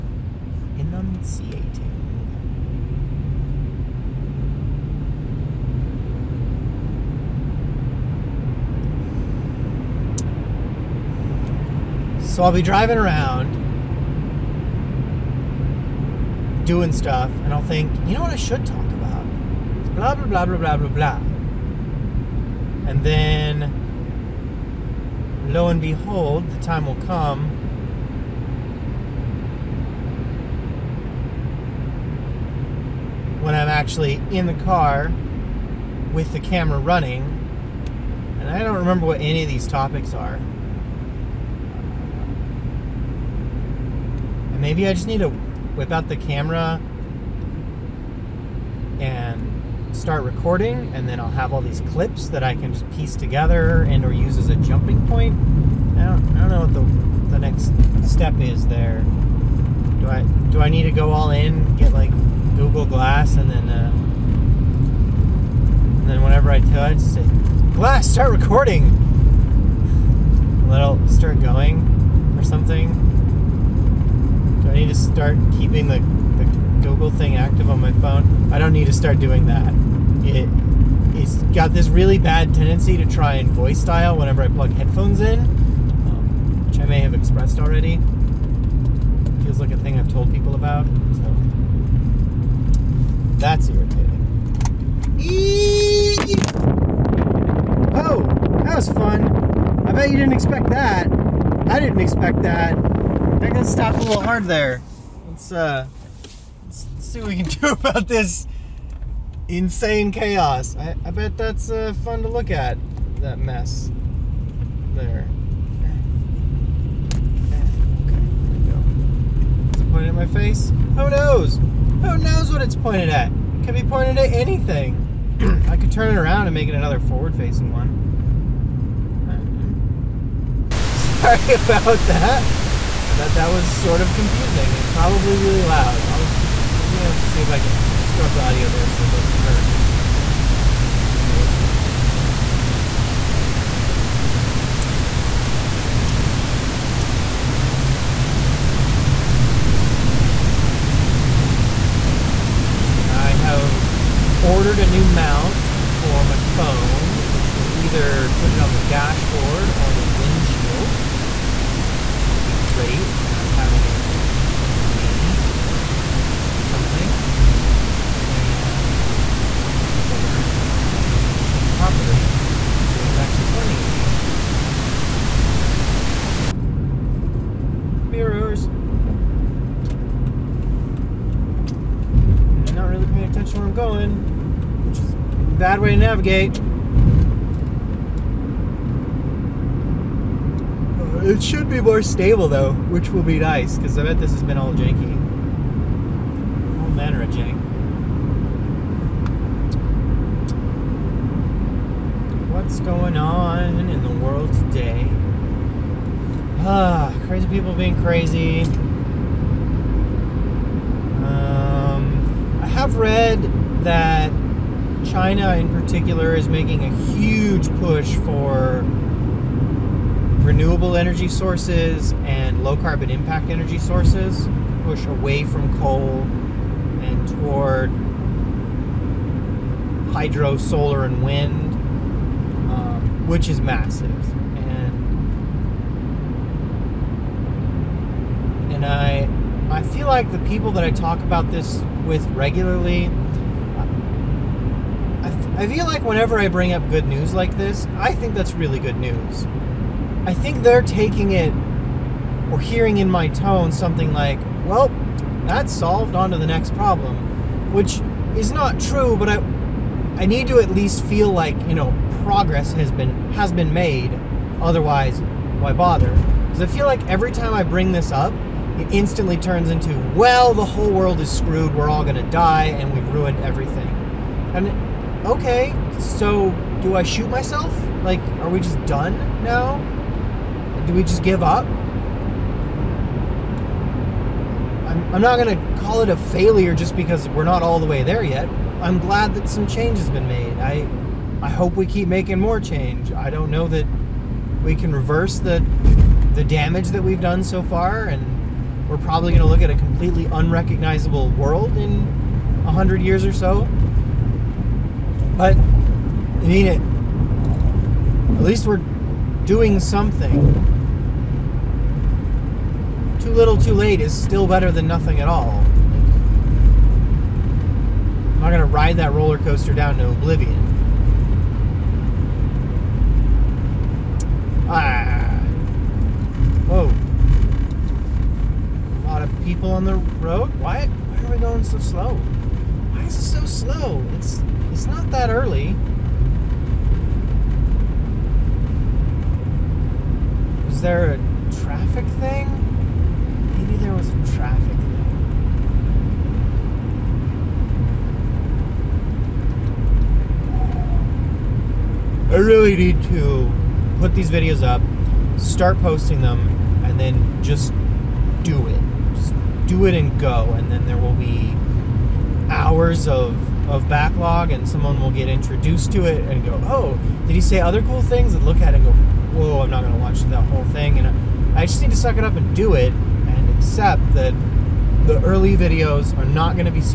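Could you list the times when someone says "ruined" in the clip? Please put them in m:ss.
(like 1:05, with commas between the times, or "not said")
4:33.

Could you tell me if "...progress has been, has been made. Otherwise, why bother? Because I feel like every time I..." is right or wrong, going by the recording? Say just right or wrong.
right.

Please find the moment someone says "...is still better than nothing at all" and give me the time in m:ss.
5:14.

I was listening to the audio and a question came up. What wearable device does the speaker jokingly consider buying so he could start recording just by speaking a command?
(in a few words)
Google Glass.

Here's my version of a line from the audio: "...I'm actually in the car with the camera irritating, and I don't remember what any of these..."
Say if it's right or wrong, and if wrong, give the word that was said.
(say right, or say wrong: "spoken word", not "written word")
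wrong: "running", not "irritating".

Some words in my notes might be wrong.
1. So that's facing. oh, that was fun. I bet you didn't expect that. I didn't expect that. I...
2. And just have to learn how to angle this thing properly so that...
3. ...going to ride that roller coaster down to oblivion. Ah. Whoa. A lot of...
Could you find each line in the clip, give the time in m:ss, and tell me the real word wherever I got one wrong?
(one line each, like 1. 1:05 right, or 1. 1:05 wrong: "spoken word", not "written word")
1. 1:30 wrong: "irritating", not "facing"
2. 2:48 right
3. 5:18 right.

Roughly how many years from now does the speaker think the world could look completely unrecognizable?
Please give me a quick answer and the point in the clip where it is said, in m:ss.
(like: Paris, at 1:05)
100, at 5:02.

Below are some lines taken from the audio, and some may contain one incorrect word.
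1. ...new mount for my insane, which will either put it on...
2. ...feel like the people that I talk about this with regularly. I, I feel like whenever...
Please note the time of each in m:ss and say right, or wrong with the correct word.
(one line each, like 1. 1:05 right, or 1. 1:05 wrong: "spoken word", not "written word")
1. 2:34 wrong: "phone", not "insane"
2. 3:59 right.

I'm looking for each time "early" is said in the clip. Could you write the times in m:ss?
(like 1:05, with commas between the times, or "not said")
5:35, 6:15.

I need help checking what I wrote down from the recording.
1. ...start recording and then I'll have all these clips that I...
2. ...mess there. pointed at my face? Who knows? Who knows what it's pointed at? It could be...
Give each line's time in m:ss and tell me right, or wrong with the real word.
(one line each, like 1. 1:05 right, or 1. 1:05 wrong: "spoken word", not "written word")
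1. 0:49 right
2. 1:53 right.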